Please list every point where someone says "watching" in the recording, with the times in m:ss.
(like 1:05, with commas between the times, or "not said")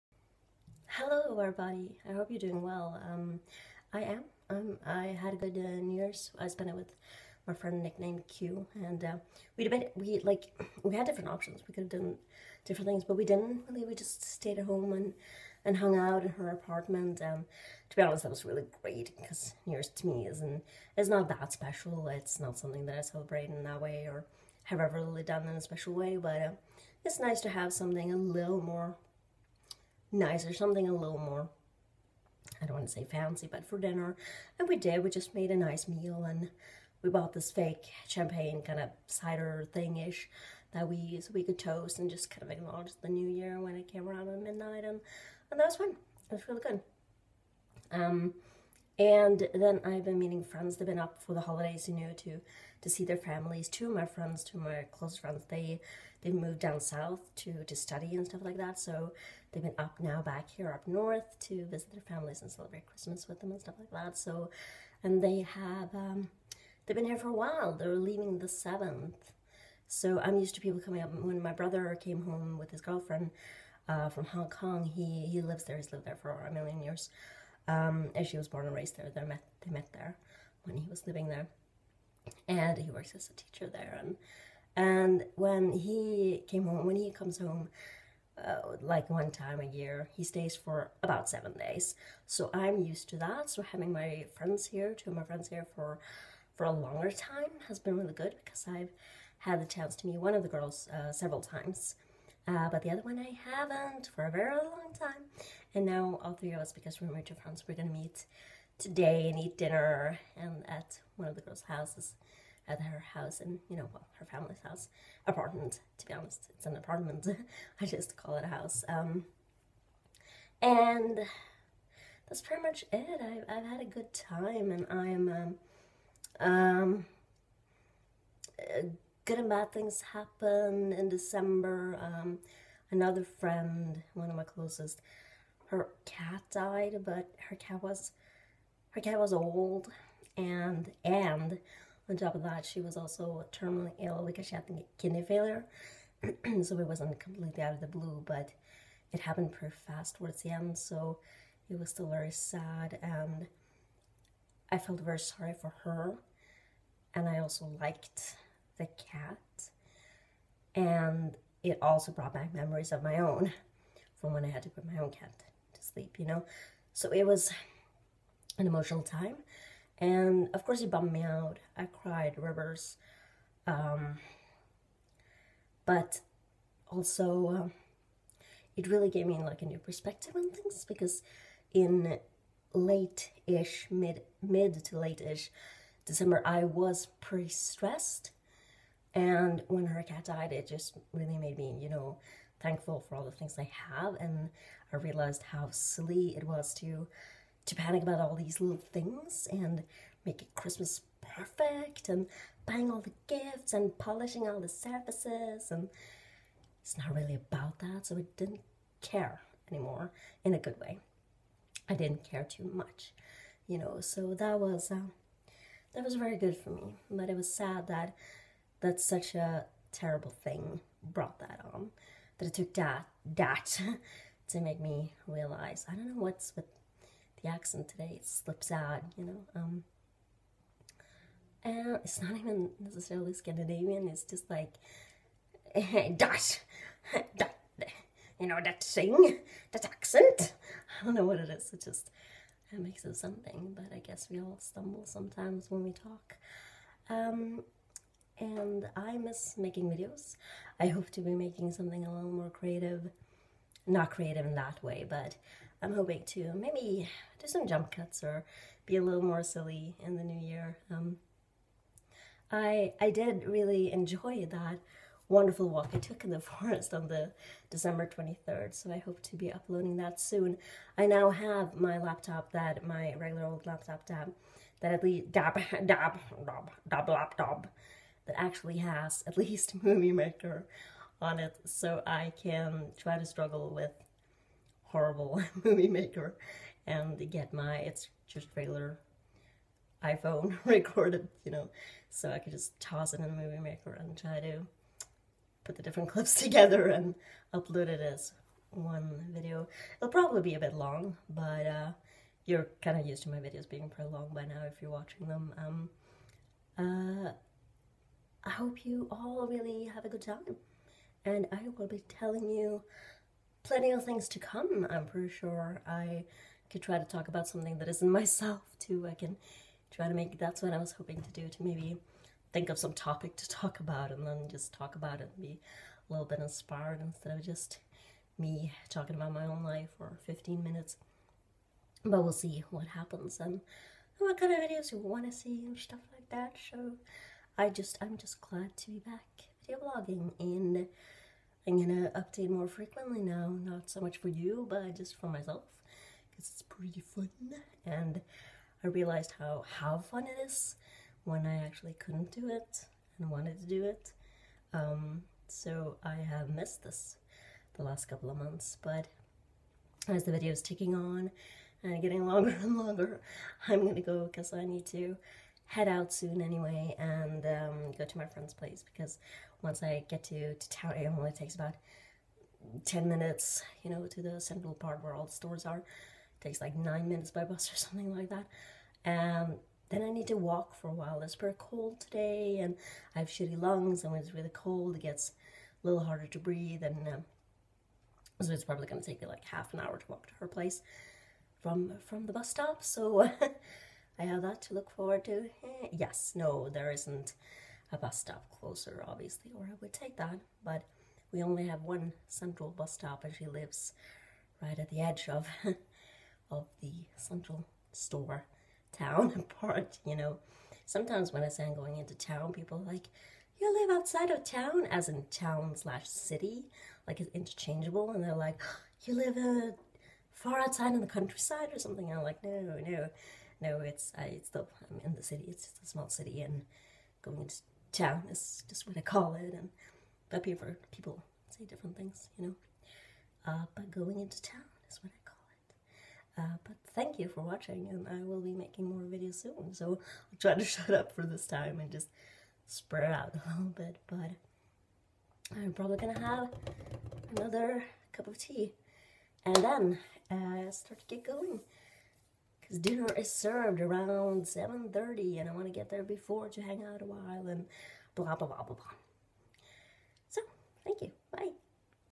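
5:04, 7:17.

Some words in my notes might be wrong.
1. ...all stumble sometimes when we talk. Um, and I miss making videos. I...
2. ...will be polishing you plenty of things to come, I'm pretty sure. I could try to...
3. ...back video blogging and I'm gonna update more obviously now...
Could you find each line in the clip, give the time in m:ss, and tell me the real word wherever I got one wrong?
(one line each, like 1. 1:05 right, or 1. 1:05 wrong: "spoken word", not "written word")
1. 4:04 right
2. 5:11 wrong: "telling", not "polishing"
3. 5:38 wrong: "frequently", not "obviously".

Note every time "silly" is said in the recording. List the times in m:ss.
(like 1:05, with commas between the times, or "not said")
3:15, 4:19.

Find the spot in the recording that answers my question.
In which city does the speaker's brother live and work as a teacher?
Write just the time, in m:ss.
1:14.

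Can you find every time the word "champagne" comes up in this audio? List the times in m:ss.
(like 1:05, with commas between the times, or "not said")
0:38.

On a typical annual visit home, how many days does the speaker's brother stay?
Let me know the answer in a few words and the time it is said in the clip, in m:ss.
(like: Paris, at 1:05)
7, at 1:31.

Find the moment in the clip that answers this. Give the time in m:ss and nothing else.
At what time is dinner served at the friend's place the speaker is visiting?
7:34.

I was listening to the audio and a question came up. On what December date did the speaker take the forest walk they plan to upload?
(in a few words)
December 23rd.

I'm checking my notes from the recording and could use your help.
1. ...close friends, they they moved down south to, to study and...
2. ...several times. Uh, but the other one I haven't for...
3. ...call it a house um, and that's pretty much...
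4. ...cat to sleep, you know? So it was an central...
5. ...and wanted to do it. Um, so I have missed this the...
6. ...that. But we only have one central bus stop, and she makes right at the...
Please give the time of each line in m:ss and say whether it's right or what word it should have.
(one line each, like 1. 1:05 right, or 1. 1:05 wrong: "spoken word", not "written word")
1. 0:54 right
2. 1:41 right
3. 1:58 right
4. 2:45 wrong: "emotional", not "central"
5. 5:53 right
6. 6:40 wrong: "lives", not "makes".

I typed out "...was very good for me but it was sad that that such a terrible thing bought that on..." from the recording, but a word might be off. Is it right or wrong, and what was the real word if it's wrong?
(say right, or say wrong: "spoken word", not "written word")
wrong: "brought", not "bought".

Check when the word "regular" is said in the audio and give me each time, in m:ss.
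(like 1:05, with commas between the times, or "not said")
4:33, 4:48.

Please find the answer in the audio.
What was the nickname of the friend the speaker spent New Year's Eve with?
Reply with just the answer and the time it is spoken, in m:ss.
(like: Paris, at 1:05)
Q, at 0:07.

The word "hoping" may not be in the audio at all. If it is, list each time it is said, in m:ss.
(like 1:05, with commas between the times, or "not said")
4:15, 5:20.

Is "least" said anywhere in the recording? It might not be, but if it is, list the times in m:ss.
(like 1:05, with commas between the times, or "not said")
4:35, 4:39.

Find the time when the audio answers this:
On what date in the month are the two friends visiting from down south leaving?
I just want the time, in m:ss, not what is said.
1:08.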